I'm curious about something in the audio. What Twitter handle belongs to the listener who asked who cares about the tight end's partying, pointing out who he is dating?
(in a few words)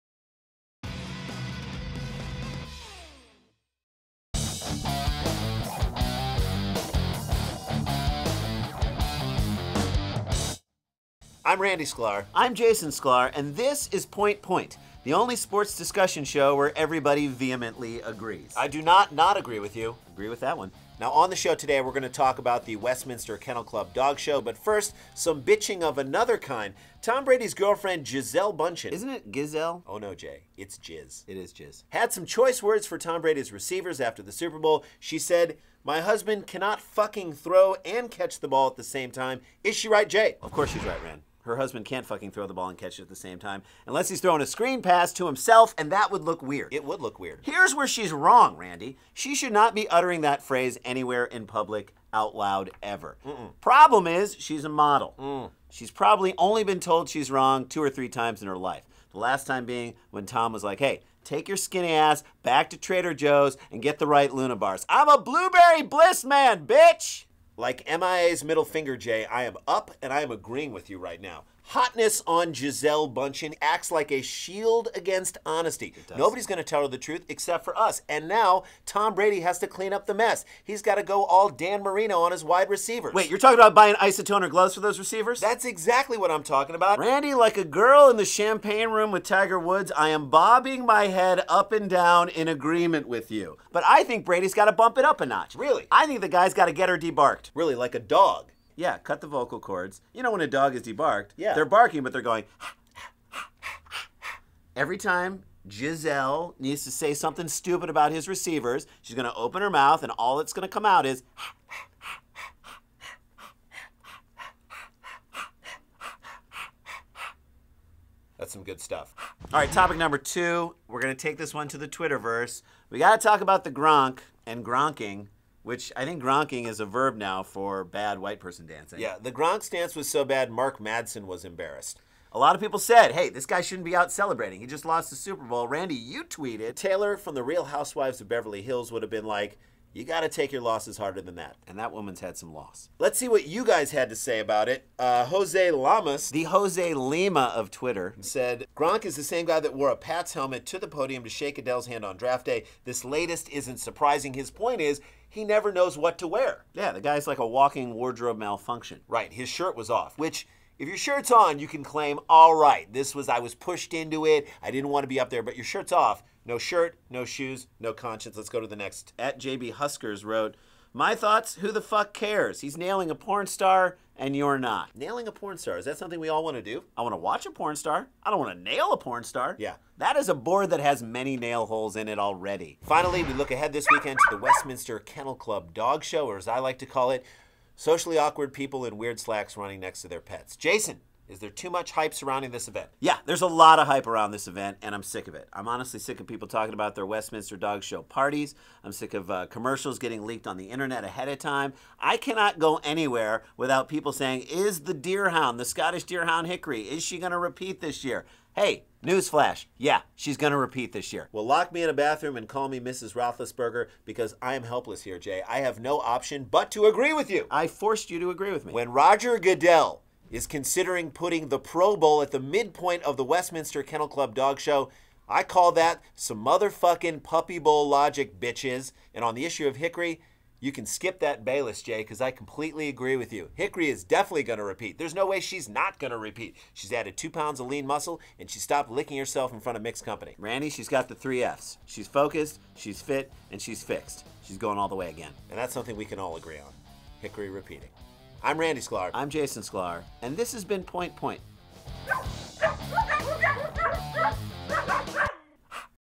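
JB Huskers.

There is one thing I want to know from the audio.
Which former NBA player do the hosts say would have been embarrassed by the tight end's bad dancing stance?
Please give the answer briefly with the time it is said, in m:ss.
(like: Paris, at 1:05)
Mark Madsen, at 2:10.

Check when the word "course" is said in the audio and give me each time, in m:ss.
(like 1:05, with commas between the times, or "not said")
0:40.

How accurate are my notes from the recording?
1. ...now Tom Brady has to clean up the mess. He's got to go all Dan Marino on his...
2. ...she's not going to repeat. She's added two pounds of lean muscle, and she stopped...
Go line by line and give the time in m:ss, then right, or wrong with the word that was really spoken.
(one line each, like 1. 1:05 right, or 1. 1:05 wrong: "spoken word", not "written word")
1. 1:18 right
2. 3:55 right.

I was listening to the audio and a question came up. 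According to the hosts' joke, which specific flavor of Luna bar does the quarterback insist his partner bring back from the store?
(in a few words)
Blueberry bliss.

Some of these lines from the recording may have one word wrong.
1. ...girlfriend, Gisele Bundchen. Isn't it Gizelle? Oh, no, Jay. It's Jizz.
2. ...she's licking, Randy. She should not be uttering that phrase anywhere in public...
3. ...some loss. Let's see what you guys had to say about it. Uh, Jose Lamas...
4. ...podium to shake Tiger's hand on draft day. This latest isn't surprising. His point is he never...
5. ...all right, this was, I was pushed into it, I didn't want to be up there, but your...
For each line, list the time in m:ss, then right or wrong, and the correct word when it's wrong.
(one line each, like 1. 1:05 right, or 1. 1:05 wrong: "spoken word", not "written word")
1. 0:27 right
2. 0:47 wrong: "wrong", not "licking"
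3. 2:22 right
4. 2:30 wrong: "Goodell", not "Tiger"
5. 2:42 right.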